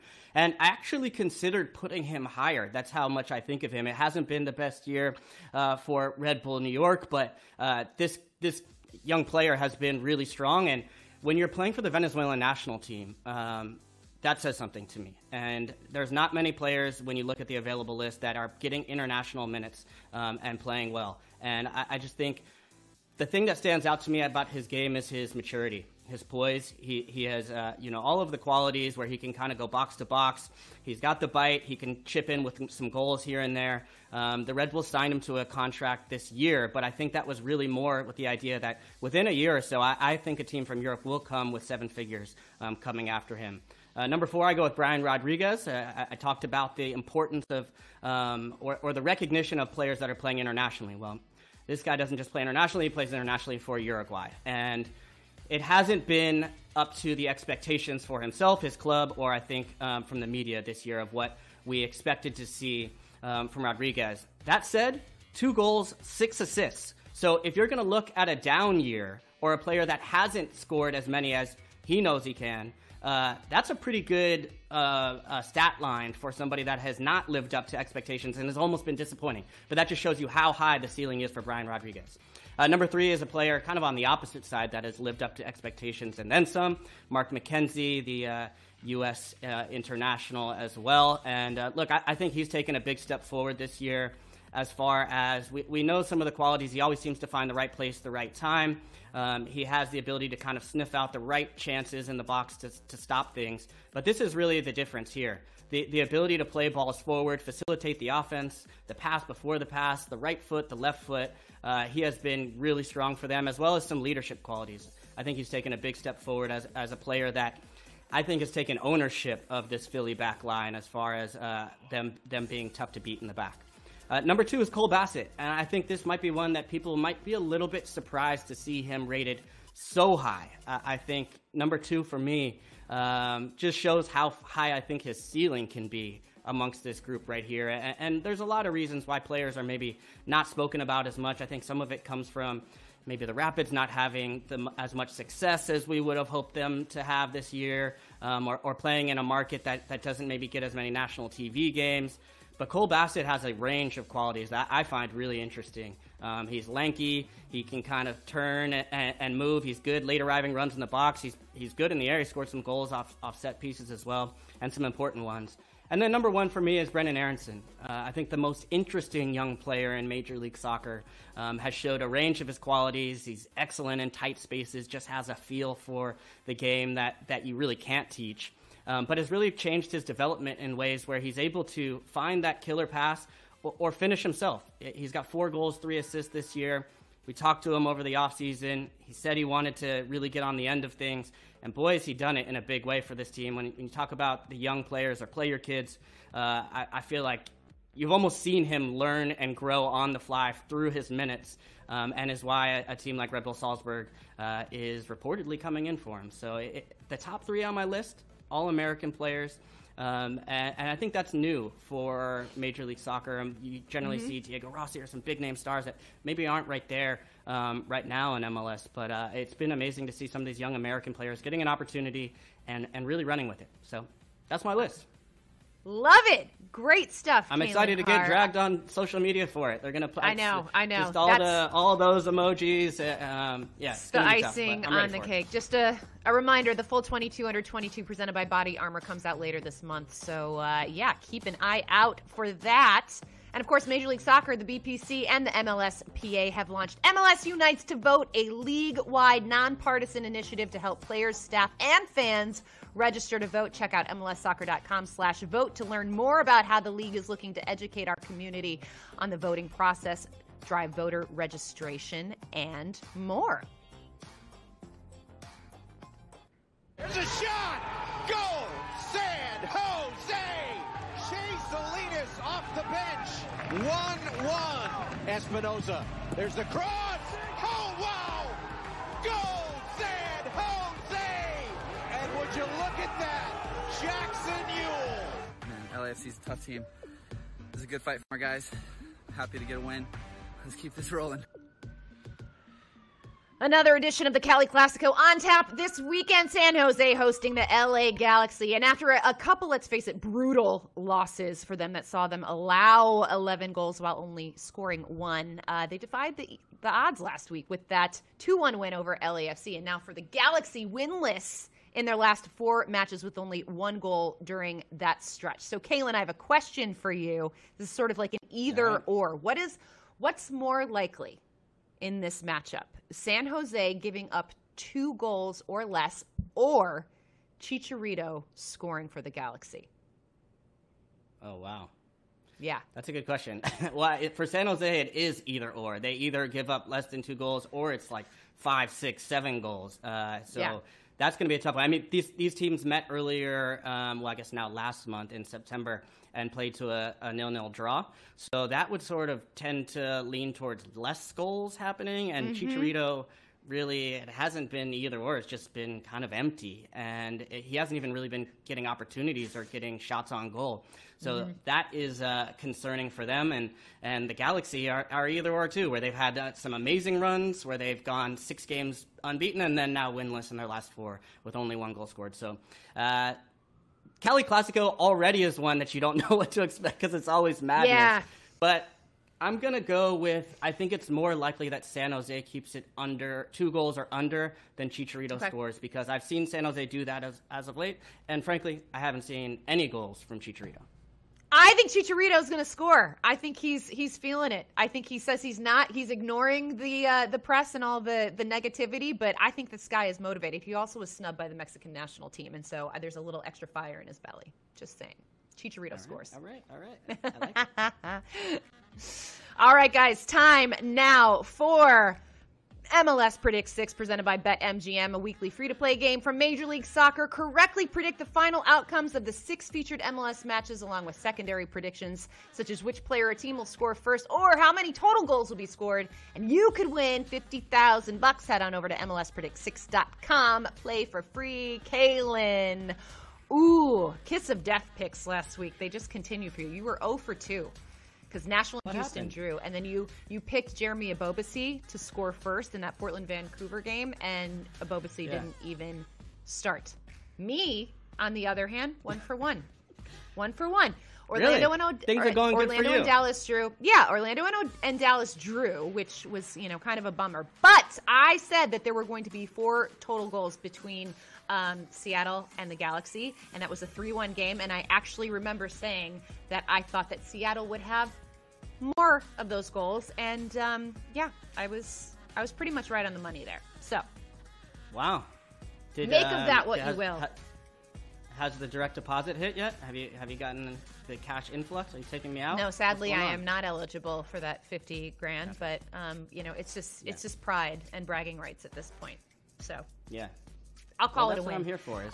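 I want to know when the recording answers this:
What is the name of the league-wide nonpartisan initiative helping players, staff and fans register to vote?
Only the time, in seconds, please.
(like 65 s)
247 s.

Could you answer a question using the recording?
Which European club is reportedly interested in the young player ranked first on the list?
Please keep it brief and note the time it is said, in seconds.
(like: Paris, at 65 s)
Red Bull Salzburg, at 203 s.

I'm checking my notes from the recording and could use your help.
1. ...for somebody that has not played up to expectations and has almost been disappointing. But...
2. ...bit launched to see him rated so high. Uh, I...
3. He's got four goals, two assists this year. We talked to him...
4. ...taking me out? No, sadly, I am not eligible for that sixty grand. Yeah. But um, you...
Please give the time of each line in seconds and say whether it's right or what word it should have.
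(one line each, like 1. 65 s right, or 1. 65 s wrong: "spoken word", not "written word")
1. 76 s wrong: "lived", not "played"
2. 127 s wrong: "surprised", not "launched"
3. 184 s wrong: "three", not "two"
4. 482 s wrong: "fifty", not "sixty".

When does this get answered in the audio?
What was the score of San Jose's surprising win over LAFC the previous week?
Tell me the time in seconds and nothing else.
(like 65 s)
308 s.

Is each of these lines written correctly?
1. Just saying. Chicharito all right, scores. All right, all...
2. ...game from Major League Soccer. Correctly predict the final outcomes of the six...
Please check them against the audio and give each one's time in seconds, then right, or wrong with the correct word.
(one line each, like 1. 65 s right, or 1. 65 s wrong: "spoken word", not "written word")
1. 404 s right
2. 415 s right.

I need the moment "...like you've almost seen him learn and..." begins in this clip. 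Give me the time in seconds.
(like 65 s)
197 s.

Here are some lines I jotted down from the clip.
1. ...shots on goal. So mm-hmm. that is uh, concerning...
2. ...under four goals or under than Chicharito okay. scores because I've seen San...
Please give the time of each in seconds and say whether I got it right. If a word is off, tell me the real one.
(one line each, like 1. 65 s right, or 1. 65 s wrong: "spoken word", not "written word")
1. 359 s right
2. 382 s wrong: "two", not "four".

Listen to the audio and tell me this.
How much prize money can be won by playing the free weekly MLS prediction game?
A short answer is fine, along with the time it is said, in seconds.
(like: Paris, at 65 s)
$50,000, at 427 s.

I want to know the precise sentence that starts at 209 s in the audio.
Um, and, and, I think that's new for Major League Soccer.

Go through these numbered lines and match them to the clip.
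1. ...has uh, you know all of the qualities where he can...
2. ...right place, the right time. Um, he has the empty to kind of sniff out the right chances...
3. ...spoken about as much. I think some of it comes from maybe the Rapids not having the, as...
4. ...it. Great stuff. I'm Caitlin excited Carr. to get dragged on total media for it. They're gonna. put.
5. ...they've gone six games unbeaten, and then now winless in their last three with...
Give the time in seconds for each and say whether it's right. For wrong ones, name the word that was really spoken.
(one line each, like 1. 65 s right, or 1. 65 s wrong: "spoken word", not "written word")
1. 27 s right
2. 97 s wrong: "ability", not "empty"
3. 140 s right
4. 226 s wrong: "social", not "total"
5. 367 s wrong: "four", not "three".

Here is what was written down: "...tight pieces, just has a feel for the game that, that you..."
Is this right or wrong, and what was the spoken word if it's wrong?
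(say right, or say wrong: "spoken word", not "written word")
wrong: "spaces", not "pieces".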